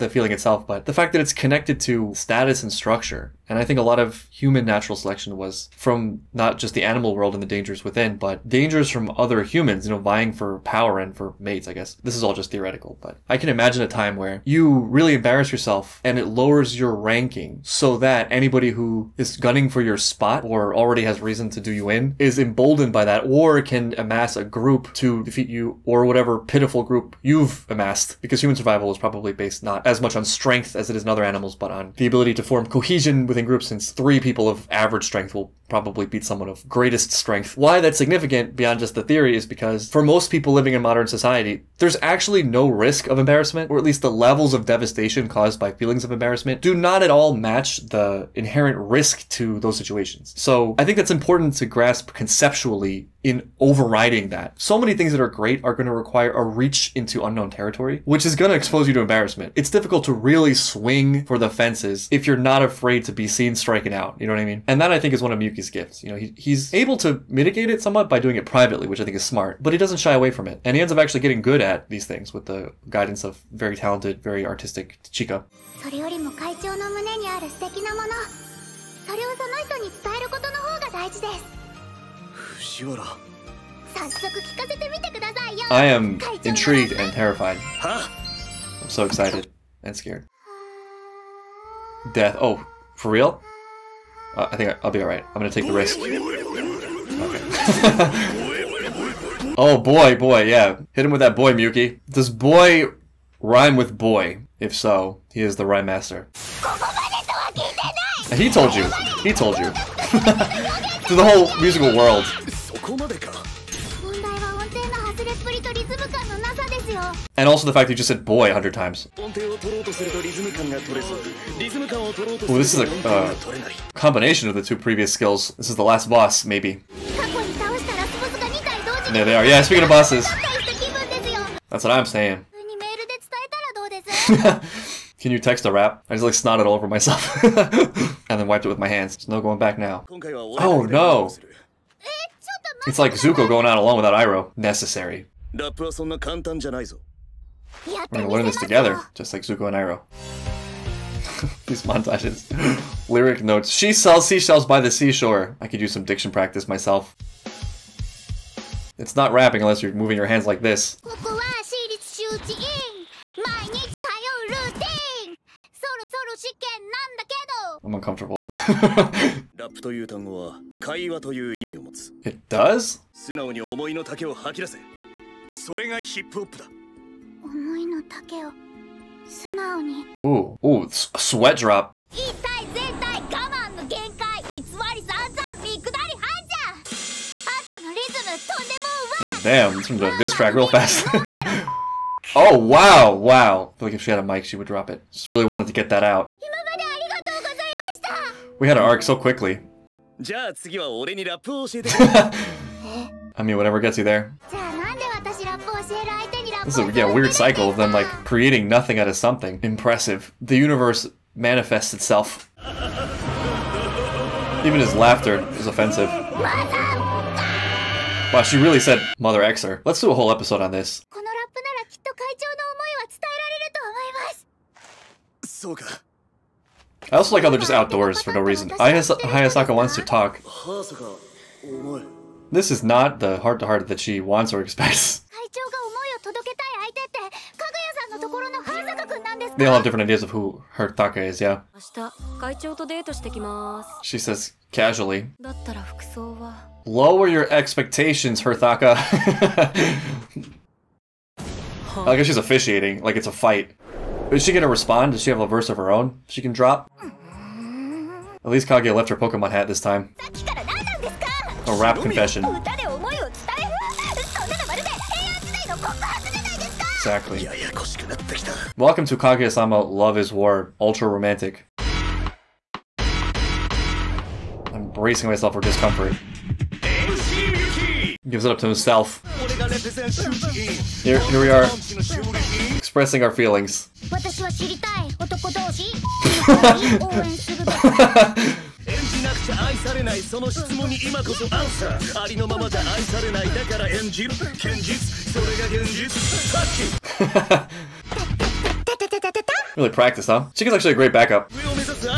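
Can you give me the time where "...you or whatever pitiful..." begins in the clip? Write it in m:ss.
0:25.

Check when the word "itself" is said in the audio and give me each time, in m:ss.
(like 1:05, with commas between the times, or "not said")
0:00, 3:31.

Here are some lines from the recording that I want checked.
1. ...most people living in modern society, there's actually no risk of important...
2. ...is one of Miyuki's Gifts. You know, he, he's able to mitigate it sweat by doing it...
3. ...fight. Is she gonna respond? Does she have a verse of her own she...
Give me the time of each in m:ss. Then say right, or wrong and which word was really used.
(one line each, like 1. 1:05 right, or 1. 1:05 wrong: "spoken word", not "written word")
1. 0:40 wrong: "embarrassment", not "important"
2. 1:05 wrong: "somewhat", not "sweat"
3. 4:13 right.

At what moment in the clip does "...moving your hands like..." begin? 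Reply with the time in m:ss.
2:39.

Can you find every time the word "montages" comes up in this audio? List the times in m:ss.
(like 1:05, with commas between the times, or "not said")
2:31.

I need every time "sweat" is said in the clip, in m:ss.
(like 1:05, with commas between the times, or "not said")
3:00.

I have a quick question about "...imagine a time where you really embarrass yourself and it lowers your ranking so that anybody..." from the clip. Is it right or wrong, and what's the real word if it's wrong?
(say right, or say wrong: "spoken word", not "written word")
right.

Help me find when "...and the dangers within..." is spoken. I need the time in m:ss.
0:07.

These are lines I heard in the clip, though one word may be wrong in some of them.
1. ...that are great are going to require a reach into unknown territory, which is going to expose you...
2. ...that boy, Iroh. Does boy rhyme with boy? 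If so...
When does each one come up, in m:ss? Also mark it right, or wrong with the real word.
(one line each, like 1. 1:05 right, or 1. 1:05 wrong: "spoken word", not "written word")
1. 0:55 right
2. 1:41 wrong: "Muki", not "Iroh".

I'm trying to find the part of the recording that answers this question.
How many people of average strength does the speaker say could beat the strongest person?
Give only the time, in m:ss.
0:33.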